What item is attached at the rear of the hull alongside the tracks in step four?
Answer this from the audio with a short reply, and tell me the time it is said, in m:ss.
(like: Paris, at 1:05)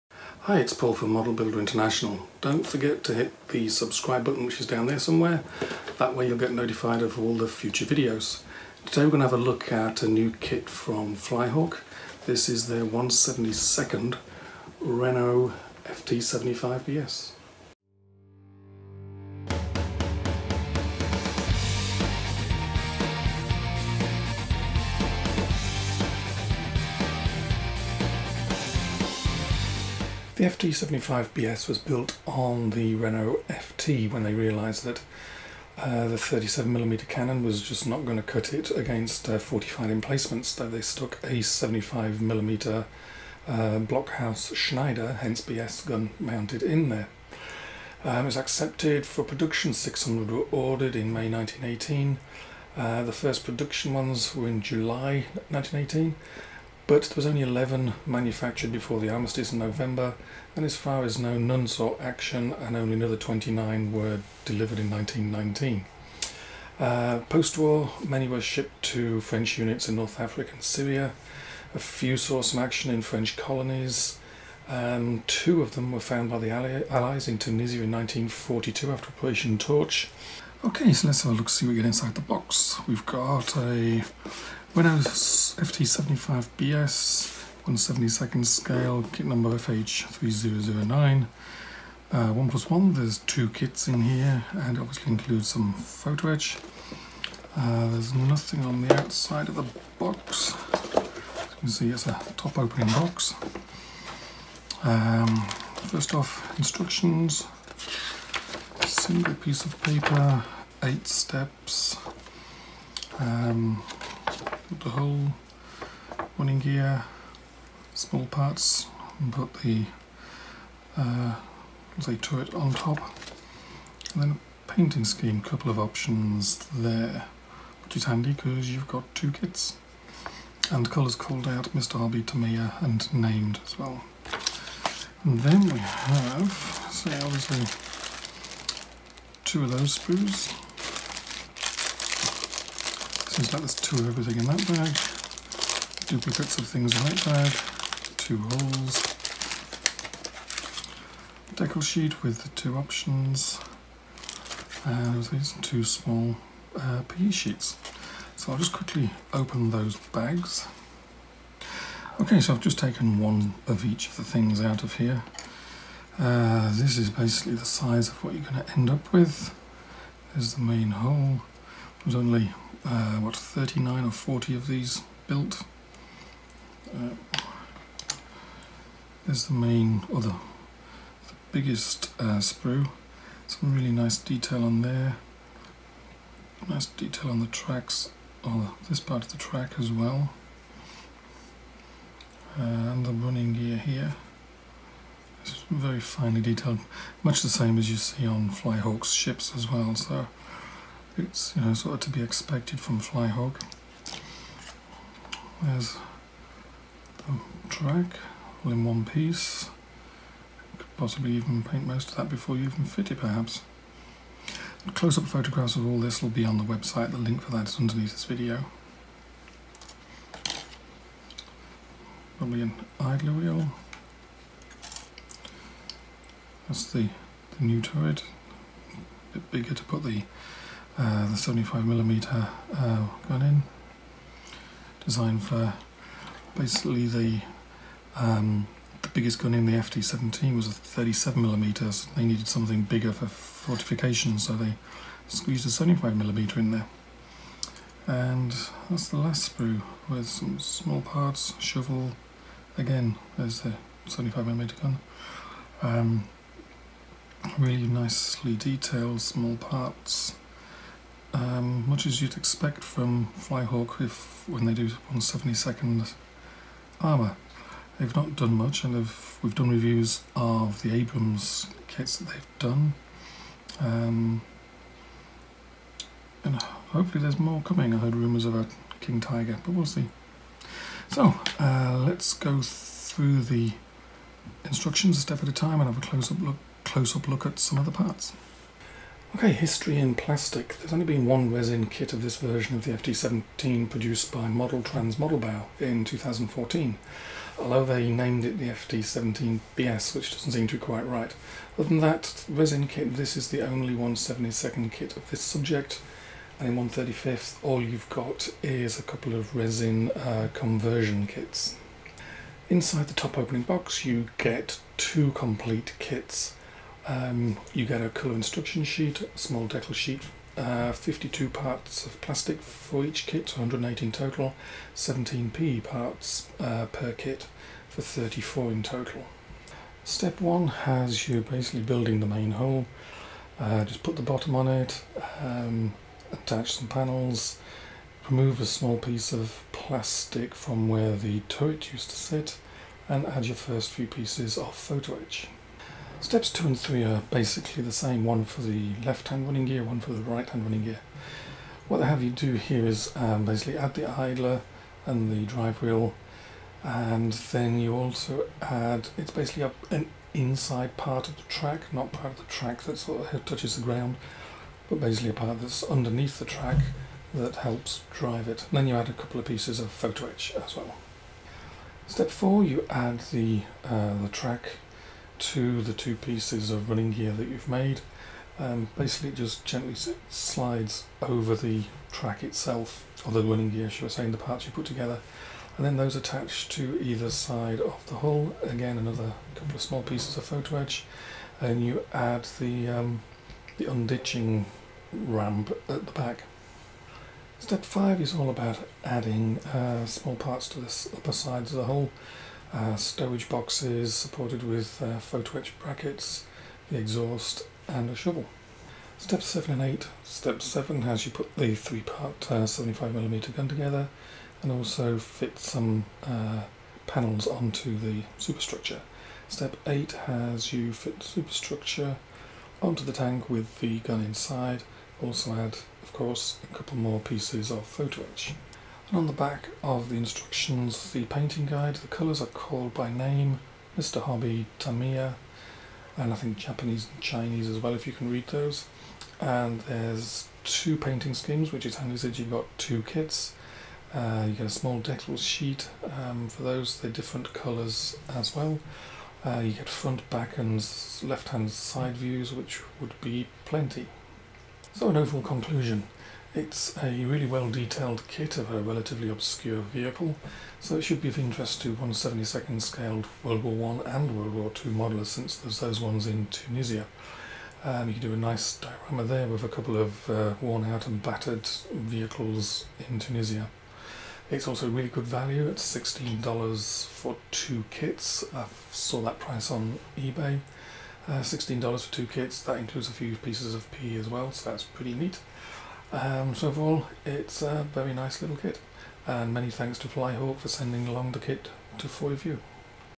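unditching ramp, at 6:33.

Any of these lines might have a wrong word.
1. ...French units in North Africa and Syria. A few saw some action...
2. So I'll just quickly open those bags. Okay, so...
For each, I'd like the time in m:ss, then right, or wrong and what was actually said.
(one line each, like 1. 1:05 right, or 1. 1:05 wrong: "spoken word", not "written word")
1. 1:09 right
2. 2:38 right.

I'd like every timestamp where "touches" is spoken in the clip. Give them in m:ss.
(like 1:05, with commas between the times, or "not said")
6:03.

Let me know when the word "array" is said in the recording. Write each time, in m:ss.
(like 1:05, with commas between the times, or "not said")
not said.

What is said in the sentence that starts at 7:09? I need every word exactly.
And on the back of the instructions, the painting guide, the colours are called by name, Mr.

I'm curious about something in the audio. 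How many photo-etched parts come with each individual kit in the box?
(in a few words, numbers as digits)
17.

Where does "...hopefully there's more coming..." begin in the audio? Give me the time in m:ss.
4:36.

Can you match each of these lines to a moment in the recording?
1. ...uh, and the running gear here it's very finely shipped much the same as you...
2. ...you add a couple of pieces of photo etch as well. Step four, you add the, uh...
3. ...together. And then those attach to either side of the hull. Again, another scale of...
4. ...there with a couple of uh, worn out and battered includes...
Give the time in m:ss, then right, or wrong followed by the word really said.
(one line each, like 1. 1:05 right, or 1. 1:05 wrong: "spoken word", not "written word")
1. 3:12 wrong: "detailed", not "shipped"
2. 6:08 right
3. 6:24 wrong: "couple", not "scale"
4. 7:49 wrong: "vehicles", not "includes".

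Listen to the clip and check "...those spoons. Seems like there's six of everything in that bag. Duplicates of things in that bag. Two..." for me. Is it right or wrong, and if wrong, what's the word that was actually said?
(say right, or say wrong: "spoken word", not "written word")
wrong: "two", not "six".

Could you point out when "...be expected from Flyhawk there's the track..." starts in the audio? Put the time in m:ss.
3:22.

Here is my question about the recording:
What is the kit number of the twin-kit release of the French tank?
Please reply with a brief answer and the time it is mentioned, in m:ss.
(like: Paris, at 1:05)
FH3009, at 1:29.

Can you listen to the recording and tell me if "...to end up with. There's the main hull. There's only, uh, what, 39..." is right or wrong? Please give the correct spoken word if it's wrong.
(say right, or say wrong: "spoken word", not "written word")
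right.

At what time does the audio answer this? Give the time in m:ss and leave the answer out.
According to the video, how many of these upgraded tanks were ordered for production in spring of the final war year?
0:49.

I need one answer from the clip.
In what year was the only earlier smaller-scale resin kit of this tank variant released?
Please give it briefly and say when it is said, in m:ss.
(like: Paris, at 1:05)
2014, at 4:56.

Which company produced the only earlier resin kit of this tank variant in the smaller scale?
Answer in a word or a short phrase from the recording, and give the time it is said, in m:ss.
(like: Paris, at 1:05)
Model Trans Modelbau, at 4:54.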